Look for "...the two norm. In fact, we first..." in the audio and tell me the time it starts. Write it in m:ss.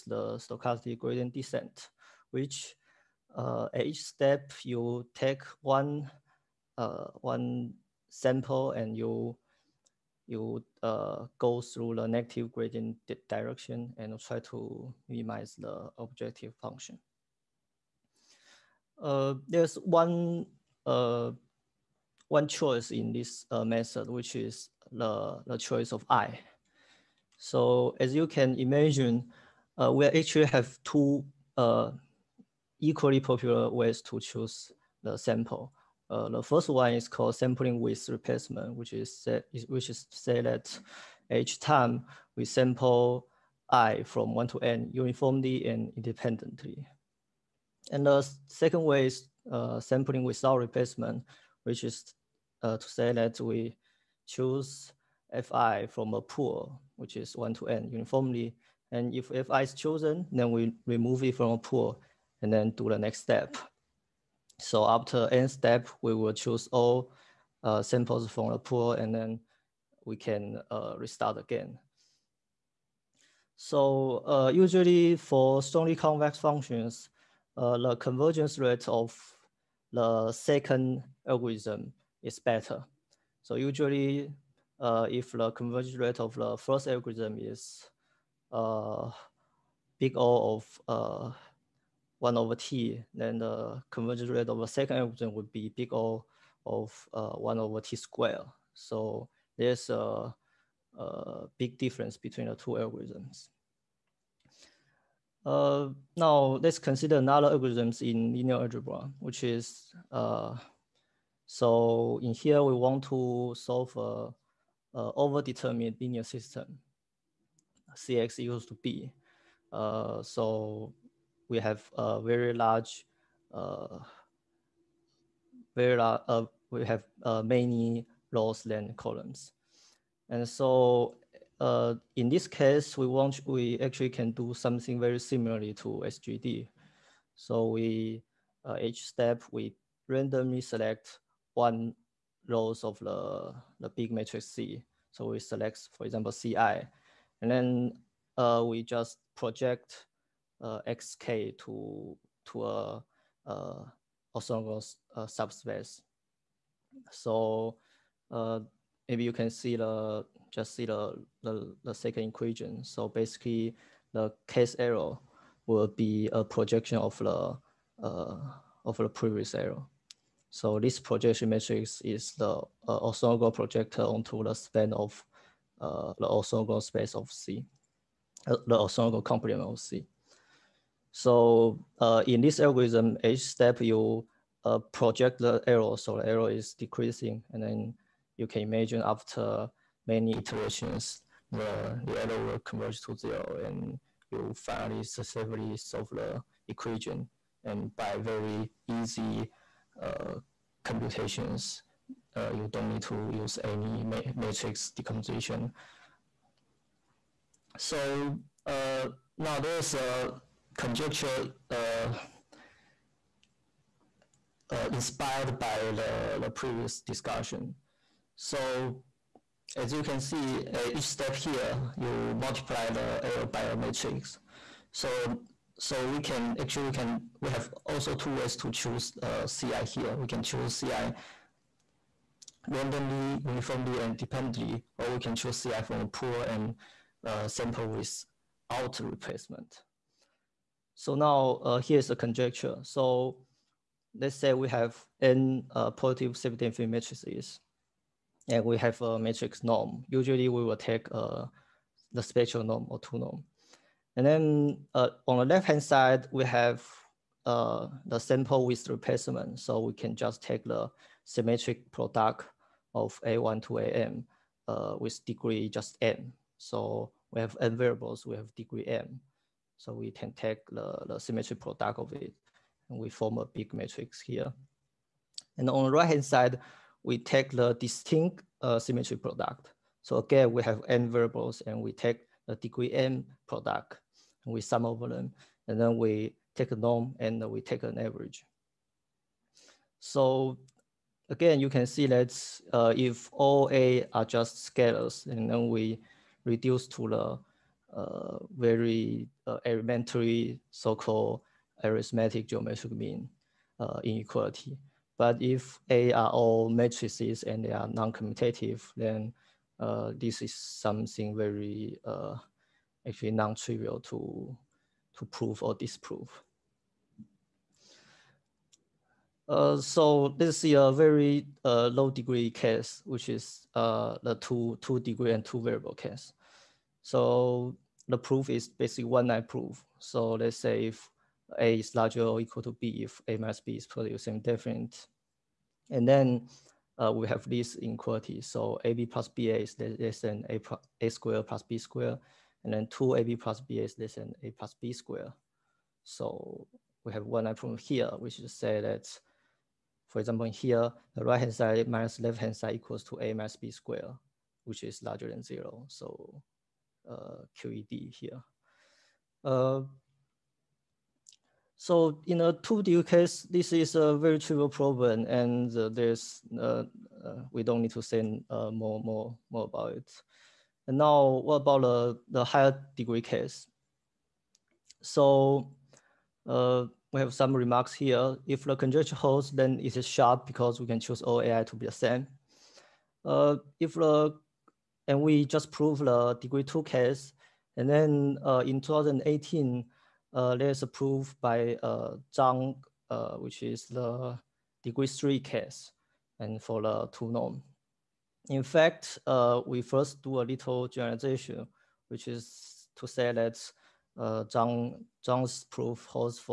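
6:36.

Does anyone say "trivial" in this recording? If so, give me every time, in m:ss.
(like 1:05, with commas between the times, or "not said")
5:13, 6:04.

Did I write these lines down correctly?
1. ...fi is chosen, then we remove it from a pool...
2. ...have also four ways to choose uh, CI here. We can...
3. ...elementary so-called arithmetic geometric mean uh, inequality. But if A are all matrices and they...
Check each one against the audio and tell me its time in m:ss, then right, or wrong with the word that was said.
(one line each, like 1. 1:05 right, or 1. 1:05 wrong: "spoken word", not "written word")
1. 0:59 right
2. 3:47 wrong: "two", not "four"
3. 4:59 right.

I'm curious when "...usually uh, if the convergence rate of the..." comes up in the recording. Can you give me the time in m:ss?
1:23.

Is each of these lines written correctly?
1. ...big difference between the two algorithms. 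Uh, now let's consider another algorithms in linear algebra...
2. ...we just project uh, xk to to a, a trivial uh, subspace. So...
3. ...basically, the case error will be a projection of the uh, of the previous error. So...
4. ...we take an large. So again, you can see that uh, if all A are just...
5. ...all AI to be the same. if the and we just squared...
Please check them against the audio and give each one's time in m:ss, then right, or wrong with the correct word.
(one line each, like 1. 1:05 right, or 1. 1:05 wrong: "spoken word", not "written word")
1. 1:41 right
2. 2:28 wrong: "orthogonal", not "trivial"
3. 2:43 right
4. 4:47 wrong: "average", not "large"
5. 6:21 wrong: "proved", not "squared".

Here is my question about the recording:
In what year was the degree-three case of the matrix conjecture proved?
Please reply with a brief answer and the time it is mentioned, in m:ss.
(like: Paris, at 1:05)
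2018, at 6:28.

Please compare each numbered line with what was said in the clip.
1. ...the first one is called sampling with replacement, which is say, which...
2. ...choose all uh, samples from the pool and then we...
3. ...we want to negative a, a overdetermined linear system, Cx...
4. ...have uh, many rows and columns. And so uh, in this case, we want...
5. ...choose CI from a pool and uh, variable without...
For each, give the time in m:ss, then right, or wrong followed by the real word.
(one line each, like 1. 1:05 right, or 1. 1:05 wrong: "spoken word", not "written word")
1. 0:36 right
2. 1:06 right
3. 1:52 wrong: "solve", not "negative"
4. 2:06 right
5. 3:55 wrong: "sample", not "variable".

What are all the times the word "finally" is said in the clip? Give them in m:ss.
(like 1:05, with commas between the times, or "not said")
3:14.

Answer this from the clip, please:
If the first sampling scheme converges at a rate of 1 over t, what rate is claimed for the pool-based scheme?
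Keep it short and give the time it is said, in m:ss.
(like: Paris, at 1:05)
O(1/t^2), at 1:37.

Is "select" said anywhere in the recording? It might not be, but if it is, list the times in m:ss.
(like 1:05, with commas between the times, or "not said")
2:20, 2:25.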